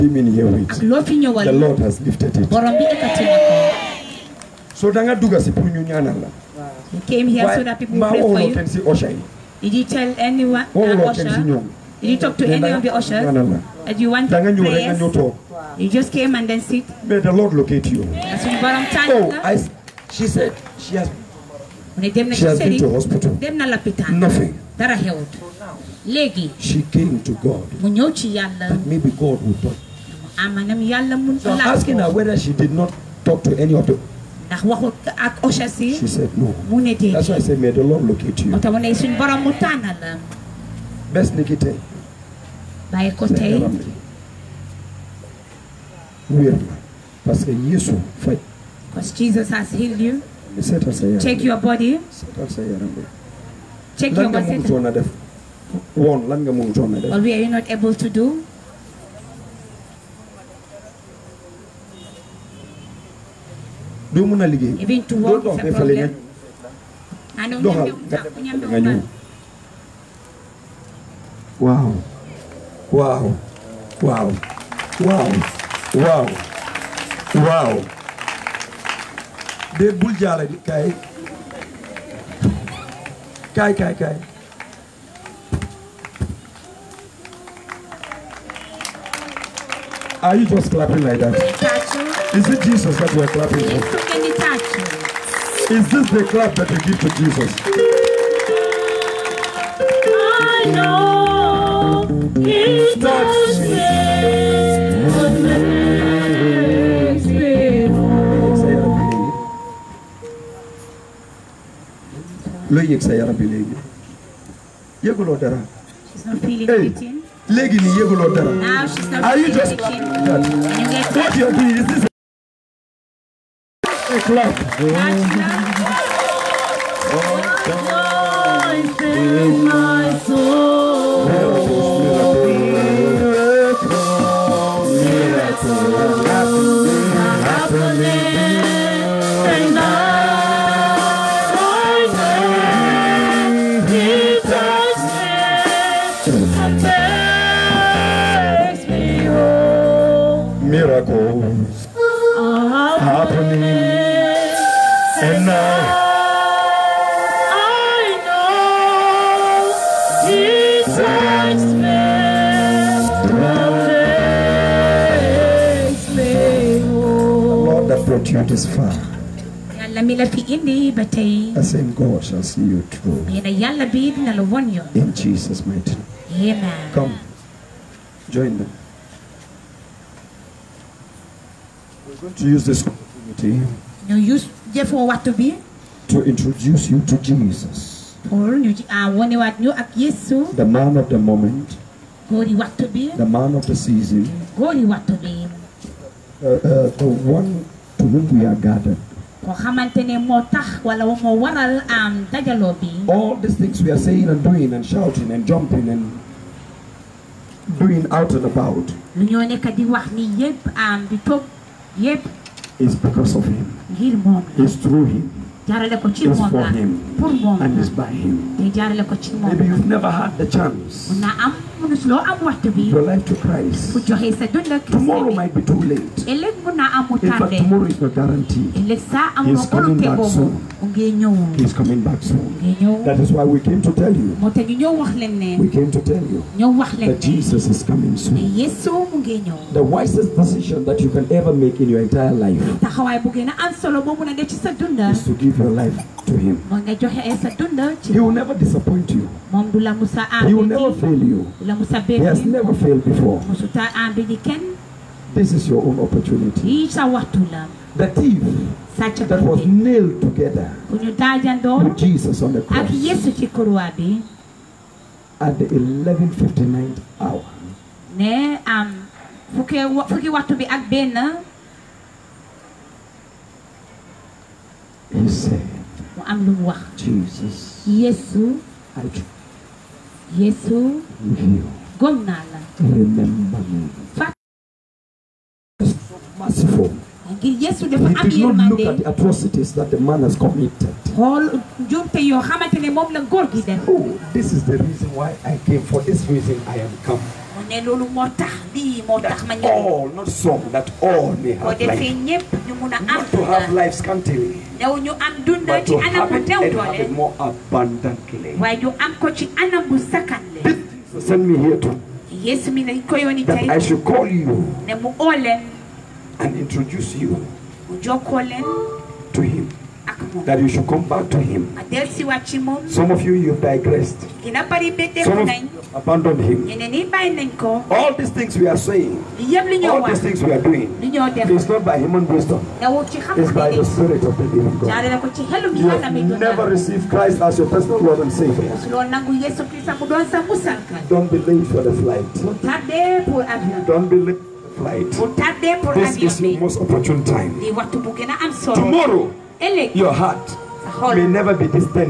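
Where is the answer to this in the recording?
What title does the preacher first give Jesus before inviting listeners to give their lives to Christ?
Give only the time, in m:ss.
3:08.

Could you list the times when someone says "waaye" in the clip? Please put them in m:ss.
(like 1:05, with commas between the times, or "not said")
0:42, 5:08.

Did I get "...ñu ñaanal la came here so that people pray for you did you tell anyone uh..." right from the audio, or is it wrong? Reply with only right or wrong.
right.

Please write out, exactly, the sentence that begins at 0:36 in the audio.
That's why I said, may the Lord locate you.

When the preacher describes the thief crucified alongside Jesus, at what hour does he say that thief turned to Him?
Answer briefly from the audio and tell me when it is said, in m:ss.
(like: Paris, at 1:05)
11.59, at 4:25.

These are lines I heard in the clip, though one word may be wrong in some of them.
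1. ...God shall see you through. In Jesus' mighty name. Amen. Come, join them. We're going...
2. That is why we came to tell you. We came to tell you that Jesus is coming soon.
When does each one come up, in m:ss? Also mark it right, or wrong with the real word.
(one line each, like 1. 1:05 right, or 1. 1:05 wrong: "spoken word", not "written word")
1. 2:51 right
2. 3:53 right.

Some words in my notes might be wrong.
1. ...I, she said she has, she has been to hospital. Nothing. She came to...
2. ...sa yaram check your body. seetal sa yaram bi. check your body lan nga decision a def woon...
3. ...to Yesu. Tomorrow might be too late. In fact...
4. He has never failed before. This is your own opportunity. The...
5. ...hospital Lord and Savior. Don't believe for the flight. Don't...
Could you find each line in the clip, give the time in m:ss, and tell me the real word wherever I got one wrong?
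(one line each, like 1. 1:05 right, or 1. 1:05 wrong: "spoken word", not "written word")
1. 0:19 right
2. 0:50 wrong: "mënutoon", not "decision"
3. 3:43 wrong: "Christ", not "Yesu"
4. 4:12 right
5. 5:37 wrong: "personal", not "hospital".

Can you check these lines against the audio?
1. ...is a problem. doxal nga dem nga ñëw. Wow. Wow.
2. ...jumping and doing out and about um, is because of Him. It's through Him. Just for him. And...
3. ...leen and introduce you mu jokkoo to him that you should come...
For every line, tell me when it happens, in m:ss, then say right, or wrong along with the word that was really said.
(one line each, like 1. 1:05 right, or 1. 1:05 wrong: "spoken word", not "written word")
1. 1:05 right
2. 3:25 right
3. 5:15 right.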